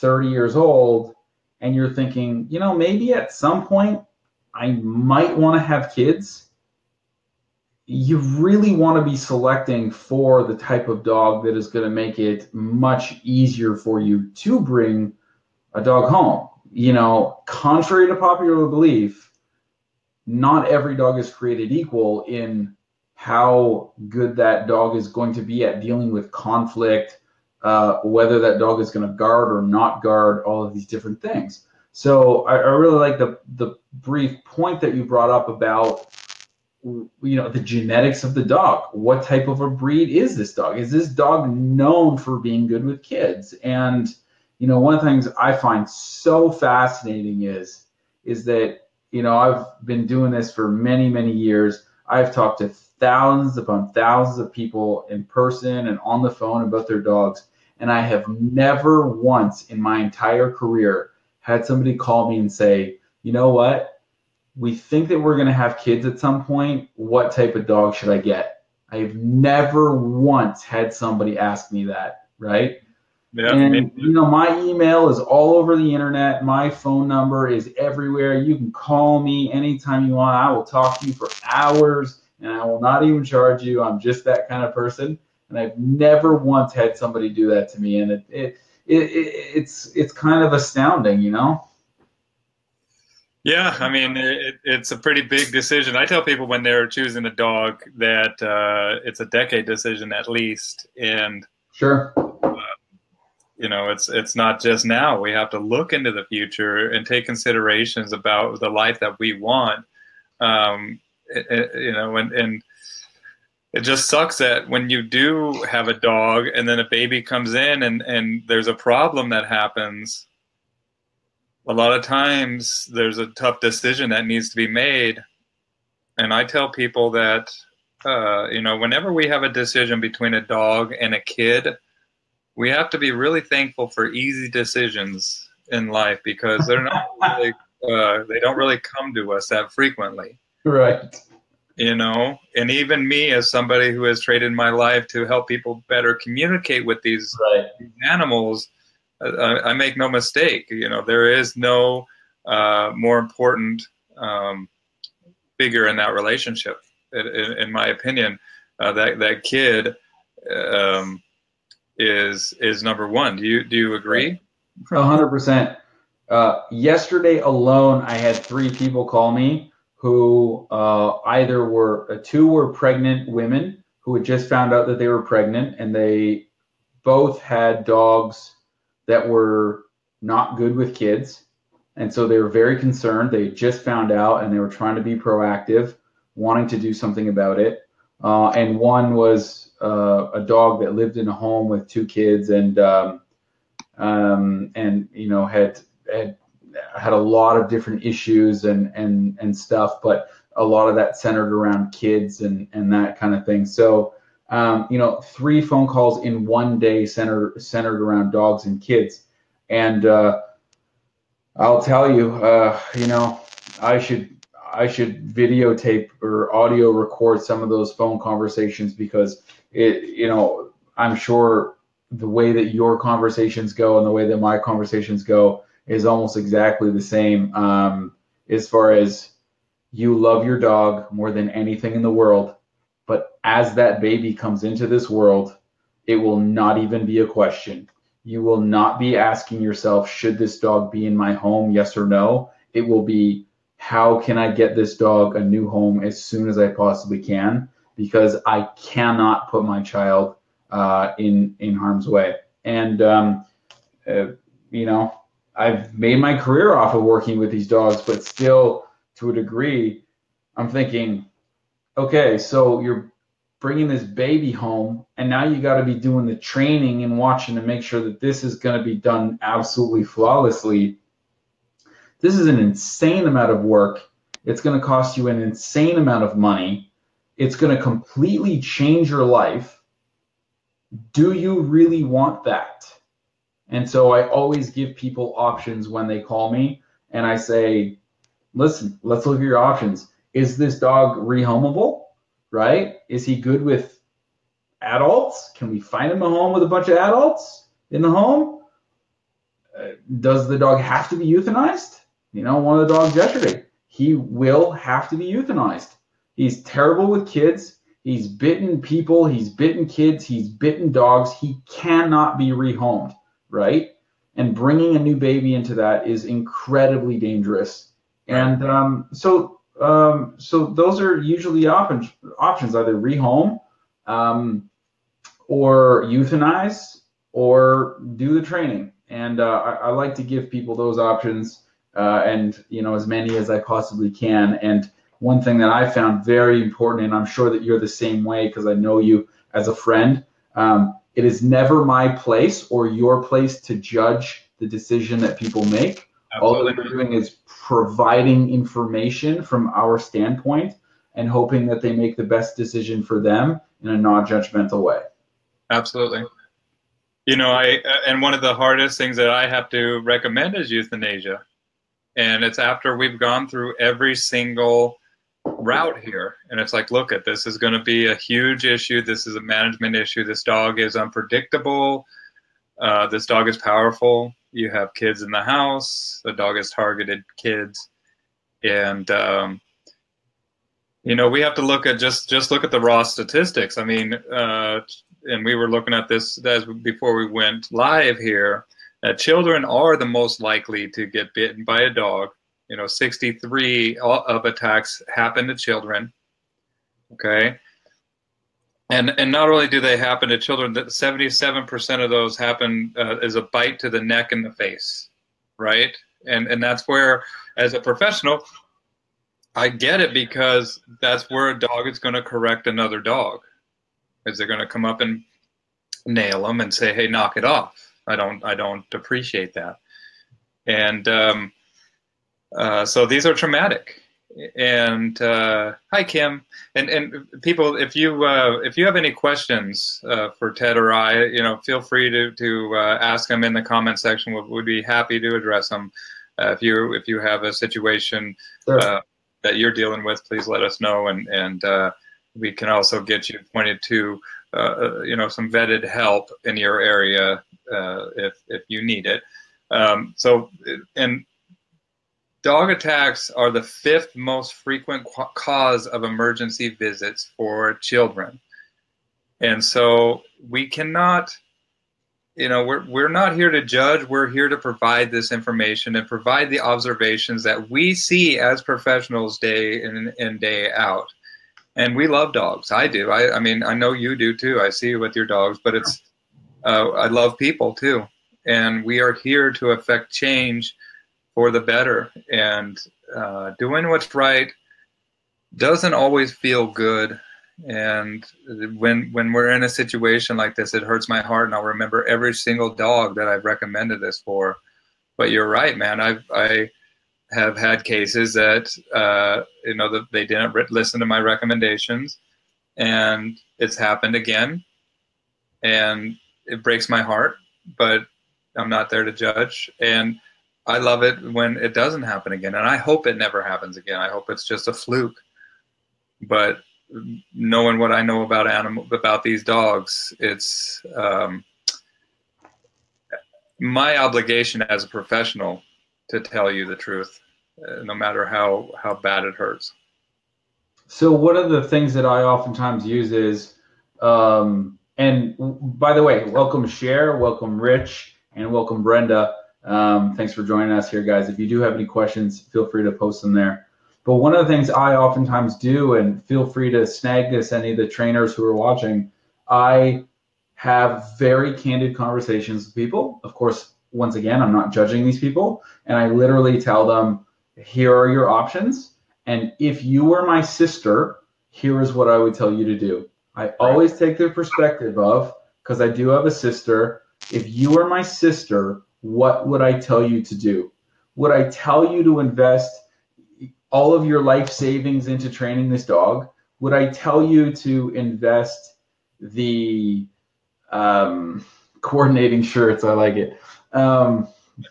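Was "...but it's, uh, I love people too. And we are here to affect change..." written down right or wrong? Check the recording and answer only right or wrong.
right.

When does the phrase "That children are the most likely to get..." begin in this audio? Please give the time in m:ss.
6:29.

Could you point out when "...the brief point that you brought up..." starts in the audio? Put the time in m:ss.
0:33.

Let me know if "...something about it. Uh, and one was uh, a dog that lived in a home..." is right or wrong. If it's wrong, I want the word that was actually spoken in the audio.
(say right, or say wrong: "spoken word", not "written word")
right.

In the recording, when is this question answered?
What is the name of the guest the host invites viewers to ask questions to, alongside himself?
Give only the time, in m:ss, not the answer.
7:10.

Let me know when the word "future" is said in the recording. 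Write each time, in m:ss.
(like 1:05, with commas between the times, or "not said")
1:46.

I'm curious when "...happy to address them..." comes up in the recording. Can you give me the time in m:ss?
7:14.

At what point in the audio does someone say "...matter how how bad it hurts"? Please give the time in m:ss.
8:47.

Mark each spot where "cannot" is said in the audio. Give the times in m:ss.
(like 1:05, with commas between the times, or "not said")
4:08, 5:11, 7:40.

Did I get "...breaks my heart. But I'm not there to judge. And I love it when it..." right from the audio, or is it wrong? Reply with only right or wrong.
right.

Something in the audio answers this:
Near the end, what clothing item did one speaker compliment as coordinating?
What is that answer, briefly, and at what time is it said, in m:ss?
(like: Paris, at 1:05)
shirts, at 9:42.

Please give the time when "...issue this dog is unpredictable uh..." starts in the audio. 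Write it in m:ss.
6:09.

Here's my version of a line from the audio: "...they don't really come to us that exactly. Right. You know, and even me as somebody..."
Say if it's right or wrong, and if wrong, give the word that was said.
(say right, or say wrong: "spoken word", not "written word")
wrong: "frequently", not "exactly".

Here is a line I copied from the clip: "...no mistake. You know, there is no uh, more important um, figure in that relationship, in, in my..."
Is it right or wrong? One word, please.
right.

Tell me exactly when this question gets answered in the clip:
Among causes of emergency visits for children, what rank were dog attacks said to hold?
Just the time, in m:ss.
7:33.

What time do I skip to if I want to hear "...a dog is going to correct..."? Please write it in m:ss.
6:51.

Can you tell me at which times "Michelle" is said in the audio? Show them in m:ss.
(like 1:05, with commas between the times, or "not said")
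not said.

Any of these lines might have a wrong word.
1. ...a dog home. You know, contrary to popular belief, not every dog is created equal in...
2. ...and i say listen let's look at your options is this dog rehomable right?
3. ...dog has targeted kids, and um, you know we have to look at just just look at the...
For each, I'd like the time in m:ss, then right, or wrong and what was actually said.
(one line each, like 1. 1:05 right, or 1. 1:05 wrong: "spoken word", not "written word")
1. 0:15 right
2. 4:47 right
3. 6:16 right.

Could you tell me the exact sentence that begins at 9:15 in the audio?
And I literally tell them, here are your options.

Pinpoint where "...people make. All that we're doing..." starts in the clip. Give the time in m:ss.
5:45.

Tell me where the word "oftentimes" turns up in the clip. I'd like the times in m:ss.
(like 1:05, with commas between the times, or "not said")
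8:52, 9:04.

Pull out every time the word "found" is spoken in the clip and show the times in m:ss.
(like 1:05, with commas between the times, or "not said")
2:54, 3:03, 5:35.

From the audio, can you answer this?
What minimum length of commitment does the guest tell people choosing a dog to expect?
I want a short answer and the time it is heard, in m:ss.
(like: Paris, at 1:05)
a decade, at 1:39.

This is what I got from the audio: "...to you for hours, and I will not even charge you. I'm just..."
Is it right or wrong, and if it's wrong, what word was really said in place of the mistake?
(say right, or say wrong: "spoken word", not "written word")
right.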